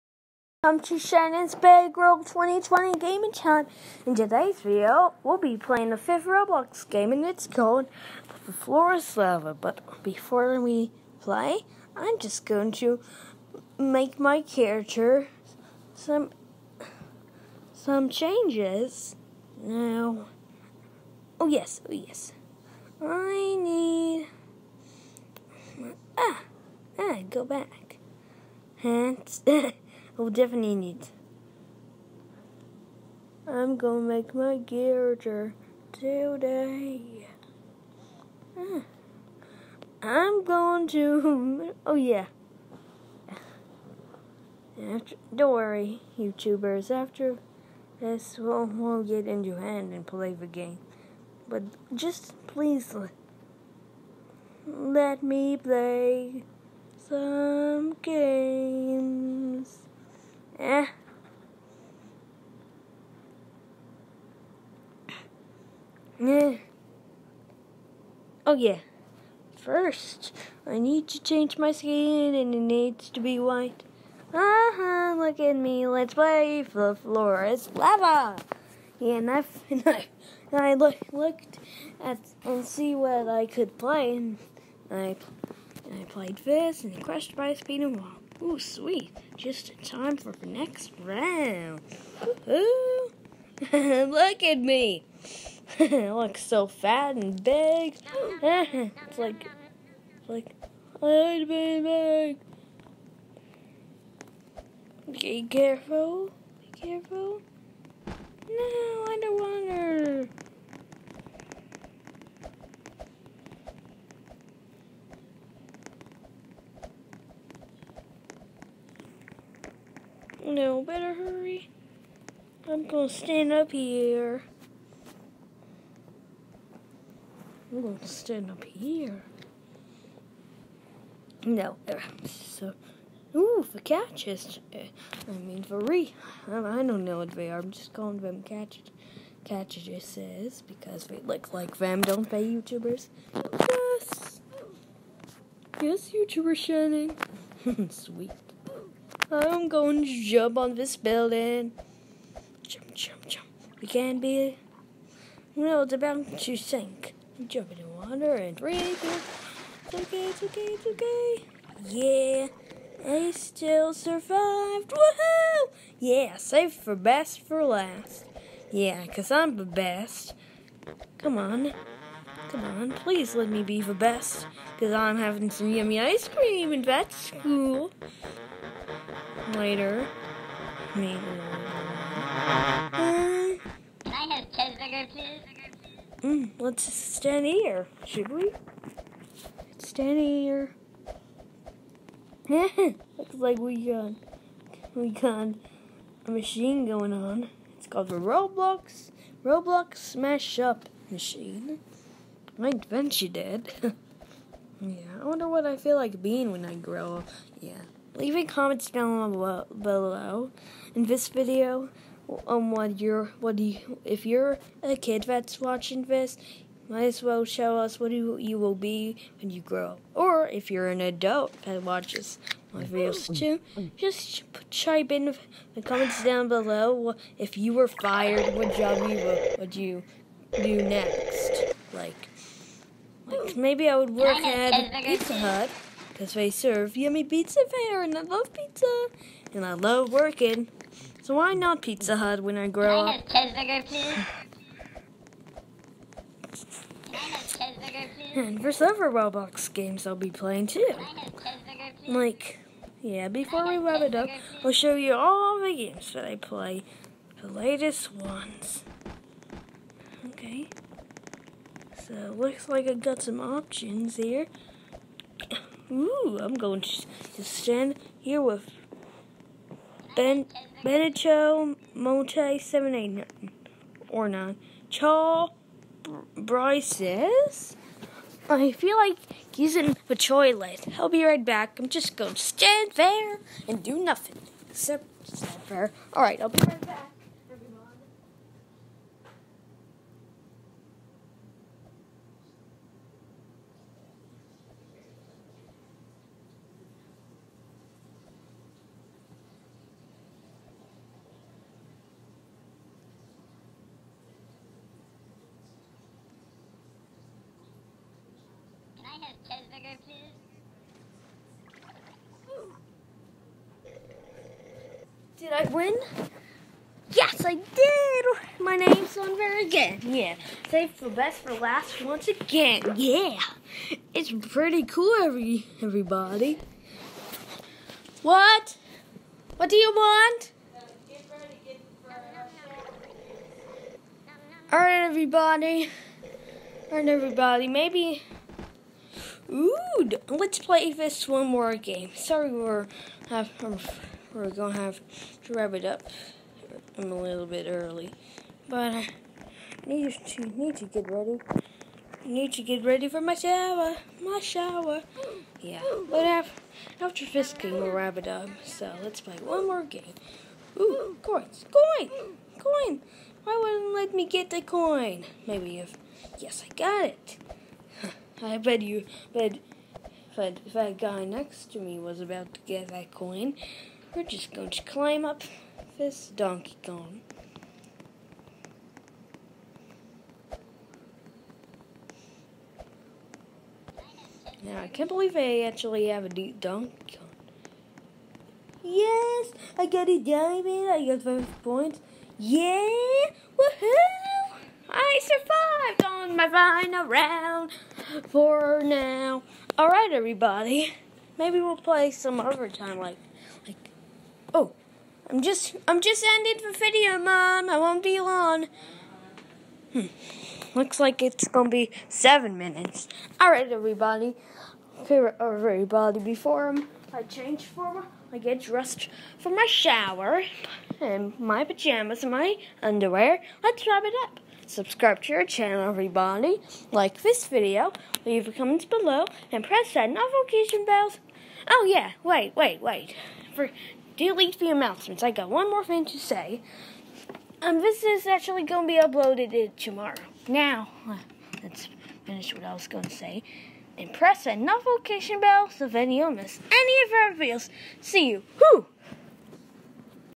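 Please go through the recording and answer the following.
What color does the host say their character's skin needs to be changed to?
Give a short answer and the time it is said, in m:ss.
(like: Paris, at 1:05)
White, at 1:13.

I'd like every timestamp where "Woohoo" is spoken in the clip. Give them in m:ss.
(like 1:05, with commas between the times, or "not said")
2:44, 6:33.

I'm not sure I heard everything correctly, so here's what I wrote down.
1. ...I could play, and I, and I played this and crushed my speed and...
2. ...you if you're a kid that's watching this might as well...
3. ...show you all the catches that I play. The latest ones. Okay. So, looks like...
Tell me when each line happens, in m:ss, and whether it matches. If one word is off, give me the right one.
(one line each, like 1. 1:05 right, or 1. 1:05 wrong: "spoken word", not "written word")
1. 1:23 right
2. 3:33 right
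3. 4:14 wrong: "games", not "catches".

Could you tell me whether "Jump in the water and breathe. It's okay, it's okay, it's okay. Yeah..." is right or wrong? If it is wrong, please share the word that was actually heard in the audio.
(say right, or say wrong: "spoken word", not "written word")
right.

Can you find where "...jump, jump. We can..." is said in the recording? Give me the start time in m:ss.
2:32.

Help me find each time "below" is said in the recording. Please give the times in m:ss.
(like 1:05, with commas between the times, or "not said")
3:29, 3:46, 7:08.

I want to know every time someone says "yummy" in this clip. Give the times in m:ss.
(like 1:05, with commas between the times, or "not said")
2:55, 3:56.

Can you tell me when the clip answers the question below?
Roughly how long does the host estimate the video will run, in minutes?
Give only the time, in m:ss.
6:52.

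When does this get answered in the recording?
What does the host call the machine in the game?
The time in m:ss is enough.
3:19.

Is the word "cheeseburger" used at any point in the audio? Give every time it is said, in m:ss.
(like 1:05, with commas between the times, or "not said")
3:04, 4:03.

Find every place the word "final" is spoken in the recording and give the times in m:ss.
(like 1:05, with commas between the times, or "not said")
6:36.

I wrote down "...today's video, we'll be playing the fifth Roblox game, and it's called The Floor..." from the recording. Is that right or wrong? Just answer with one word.
right.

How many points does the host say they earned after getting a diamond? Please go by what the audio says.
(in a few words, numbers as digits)
5.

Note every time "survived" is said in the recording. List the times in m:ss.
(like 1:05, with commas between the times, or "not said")
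2:43, 6:35.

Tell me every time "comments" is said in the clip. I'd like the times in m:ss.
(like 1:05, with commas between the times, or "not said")
3:28, 3:45, 7:08.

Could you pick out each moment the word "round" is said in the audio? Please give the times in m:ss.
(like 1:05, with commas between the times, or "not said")
1:31, 6:37.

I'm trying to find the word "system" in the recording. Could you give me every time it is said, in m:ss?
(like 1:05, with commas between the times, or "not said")
not said.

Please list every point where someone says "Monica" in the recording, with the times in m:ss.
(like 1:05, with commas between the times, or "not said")
not said.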